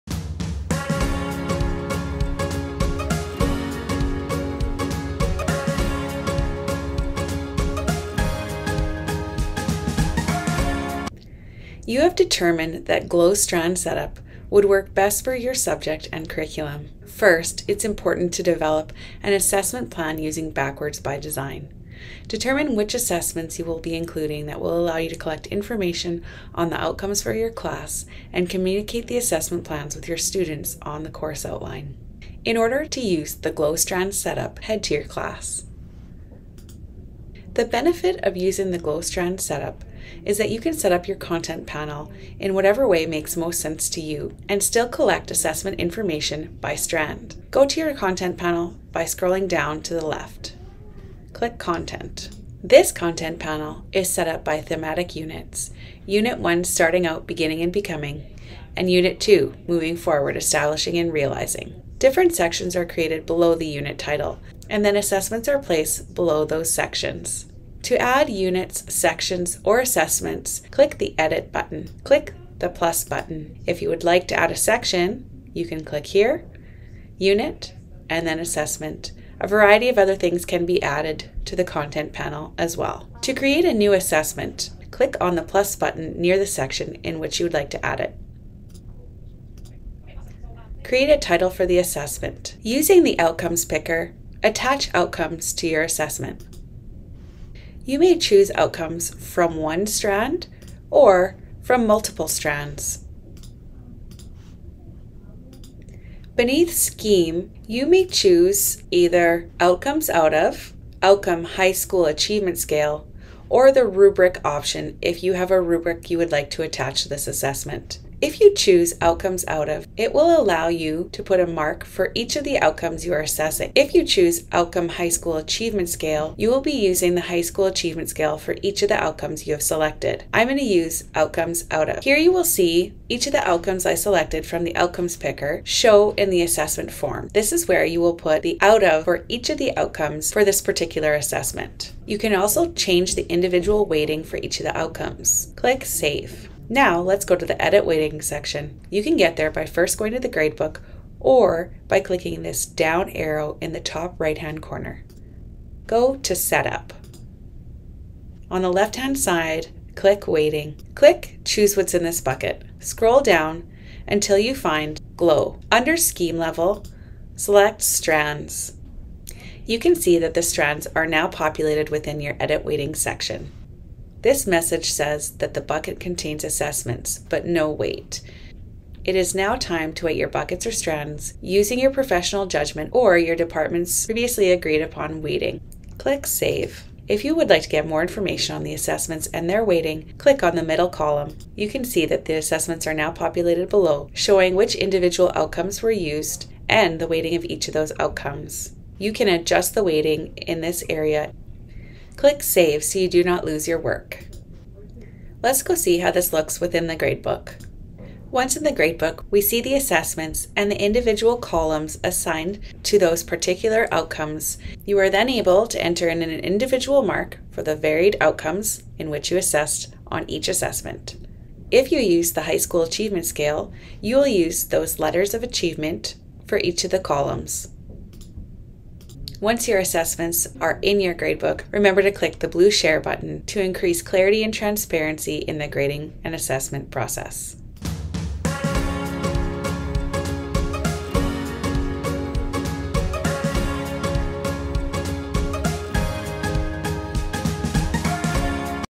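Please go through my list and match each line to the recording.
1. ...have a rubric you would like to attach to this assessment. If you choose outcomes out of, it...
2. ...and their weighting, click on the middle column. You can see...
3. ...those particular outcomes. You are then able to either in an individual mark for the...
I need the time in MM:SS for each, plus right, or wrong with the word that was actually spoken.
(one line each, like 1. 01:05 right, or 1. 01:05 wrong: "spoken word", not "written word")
1. 01:55 right
2. 03:09 right
3. 03:32 wrong: "enter", not "either".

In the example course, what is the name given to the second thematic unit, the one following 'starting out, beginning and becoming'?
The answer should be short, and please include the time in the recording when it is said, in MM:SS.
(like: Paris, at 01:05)
moving forward, establishing and realizing, at 00:59.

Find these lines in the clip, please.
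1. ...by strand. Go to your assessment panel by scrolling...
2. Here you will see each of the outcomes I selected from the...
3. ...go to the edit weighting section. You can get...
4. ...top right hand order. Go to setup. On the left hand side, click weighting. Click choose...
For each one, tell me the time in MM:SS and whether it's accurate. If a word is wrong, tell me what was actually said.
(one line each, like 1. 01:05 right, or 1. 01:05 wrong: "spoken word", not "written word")
1. 00:46 wrong: "content", not "assessment"
2. 02:12 right
3. 02:27 right
4. 02:33 wrong: "corner", not "order".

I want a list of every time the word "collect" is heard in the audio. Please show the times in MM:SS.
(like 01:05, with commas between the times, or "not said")
00:25, 00:44.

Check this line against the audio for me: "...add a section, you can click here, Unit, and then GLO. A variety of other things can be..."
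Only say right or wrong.
wrong.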